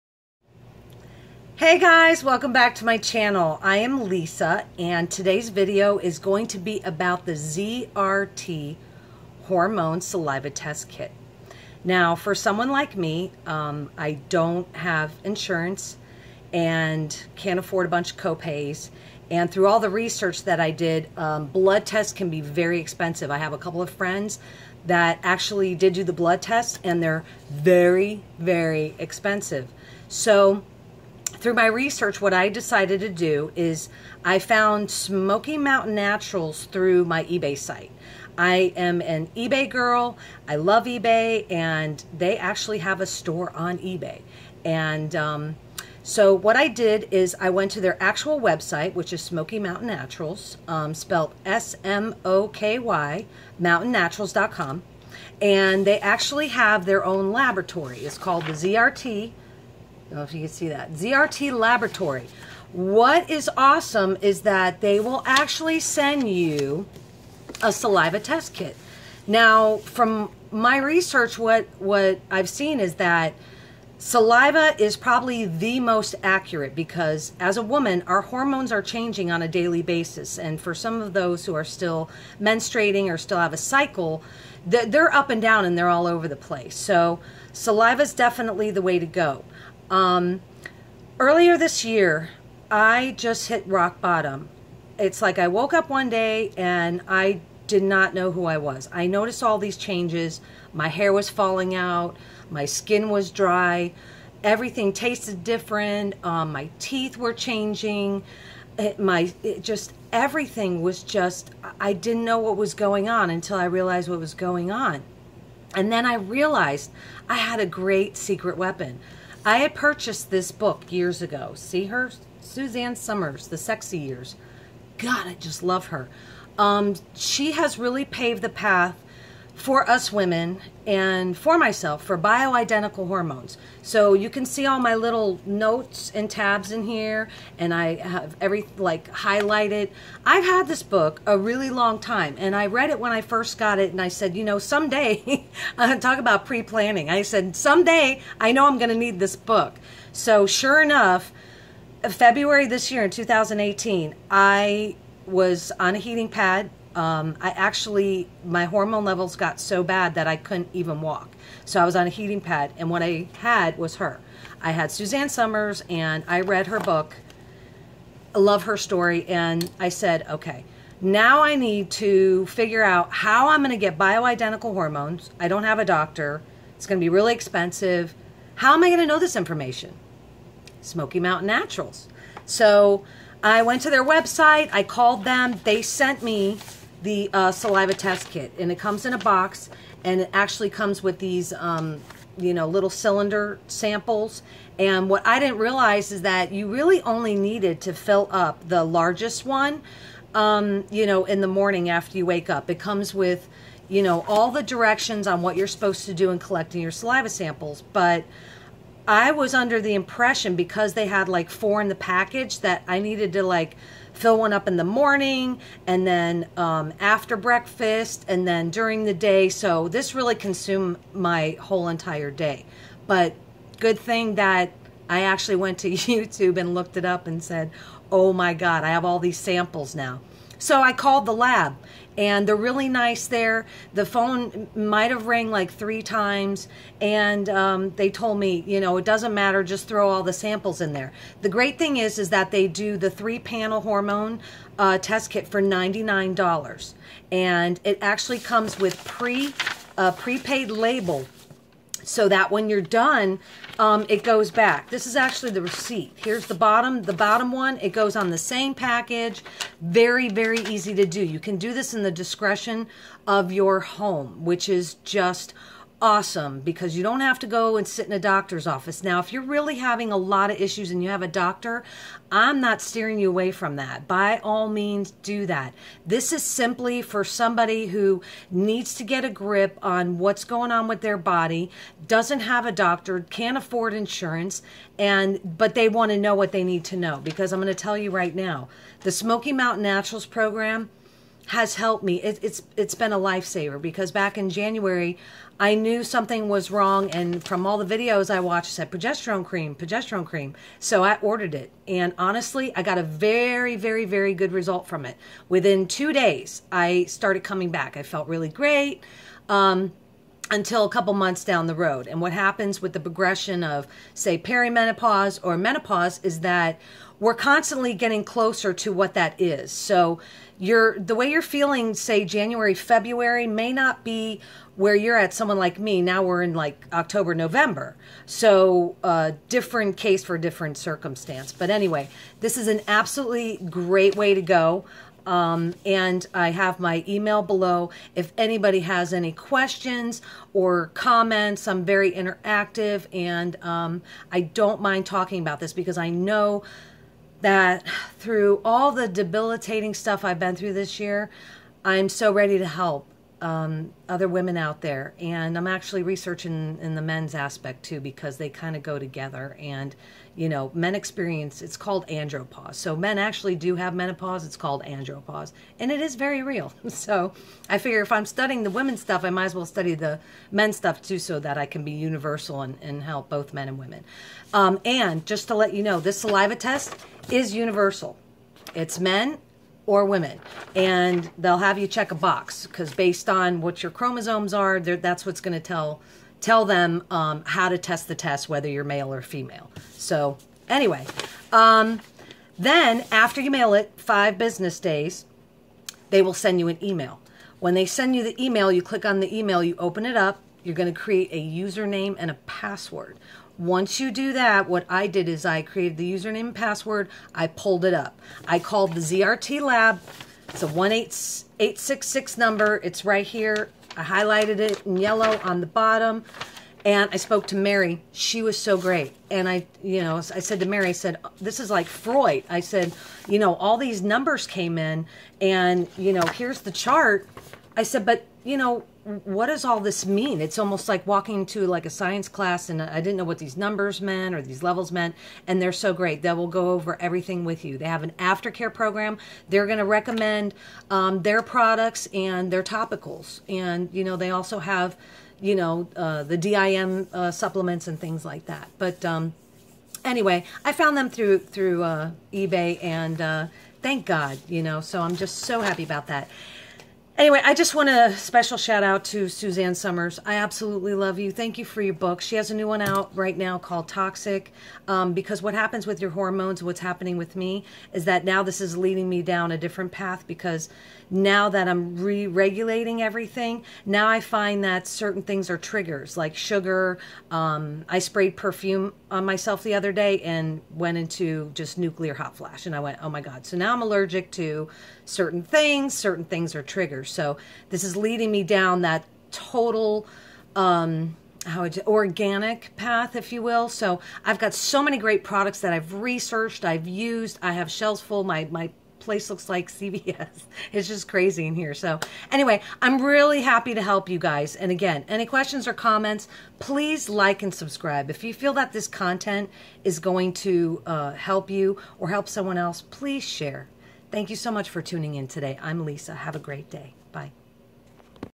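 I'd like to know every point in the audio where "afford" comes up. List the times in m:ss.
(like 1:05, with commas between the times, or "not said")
0:17, 4:43.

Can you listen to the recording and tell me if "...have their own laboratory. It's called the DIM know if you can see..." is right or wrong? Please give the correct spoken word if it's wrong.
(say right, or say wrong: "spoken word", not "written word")
wrong: "ZRT", not "DIM".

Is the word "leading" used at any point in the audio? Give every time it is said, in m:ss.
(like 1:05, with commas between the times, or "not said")
7:48, 8:07.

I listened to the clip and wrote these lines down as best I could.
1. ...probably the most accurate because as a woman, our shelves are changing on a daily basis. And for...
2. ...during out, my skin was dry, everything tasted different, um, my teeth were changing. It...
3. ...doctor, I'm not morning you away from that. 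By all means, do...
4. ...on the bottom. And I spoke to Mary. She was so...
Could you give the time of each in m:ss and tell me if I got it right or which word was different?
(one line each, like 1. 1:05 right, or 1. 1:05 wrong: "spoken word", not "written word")
1. 1:14 wrong: "hormones", not "shelves"
2. 1:41 wrong: "falling", not "during"
3. 4:31 wrong: "steering", not "morning"
4. 6:55 right.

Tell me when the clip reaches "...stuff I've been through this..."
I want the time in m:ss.
5:49.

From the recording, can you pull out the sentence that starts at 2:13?
So you can see all my little notes and tabs in here and I have every like highlighted.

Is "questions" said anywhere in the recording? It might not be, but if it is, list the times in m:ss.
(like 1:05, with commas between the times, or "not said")
5:39, 8:25.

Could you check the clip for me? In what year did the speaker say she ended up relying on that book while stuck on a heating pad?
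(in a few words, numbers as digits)
2018.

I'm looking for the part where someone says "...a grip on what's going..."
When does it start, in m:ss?
4:39.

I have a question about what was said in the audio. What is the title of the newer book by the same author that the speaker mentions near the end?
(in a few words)
Toxic.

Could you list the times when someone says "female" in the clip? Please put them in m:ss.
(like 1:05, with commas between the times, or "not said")
6:29.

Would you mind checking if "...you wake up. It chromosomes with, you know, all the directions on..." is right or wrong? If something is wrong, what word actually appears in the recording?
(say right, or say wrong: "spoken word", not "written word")
wrong: "comes", not "chromosomes".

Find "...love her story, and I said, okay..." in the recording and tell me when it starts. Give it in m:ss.
2:48.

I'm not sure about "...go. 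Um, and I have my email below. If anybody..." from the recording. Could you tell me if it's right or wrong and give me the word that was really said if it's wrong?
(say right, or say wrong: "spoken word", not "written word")
right.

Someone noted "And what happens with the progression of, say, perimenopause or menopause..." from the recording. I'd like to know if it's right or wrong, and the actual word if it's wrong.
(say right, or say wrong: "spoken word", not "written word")
right.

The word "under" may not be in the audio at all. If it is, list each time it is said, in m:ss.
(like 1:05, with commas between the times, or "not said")
3:29.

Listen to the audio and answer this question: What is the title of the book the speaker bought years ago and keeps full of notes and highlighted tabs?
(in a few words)
The Sexy Years.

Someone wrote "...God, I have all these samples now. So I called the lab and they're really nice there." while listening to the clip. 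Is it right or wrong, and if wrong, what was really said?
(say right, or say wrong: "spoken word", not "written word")
right.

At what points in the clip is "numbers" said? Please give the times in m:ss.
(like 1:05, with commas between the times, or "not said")
6:52, 7:04, 7:13.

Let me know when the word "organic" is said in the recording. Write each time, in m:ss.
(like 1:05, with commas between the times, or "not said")
8:11.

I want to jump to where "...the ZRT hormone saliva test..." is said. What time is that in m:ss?
0:07.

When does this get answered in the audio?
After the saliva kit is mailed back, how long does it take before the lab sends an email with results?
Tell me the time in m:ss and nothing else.
6:33.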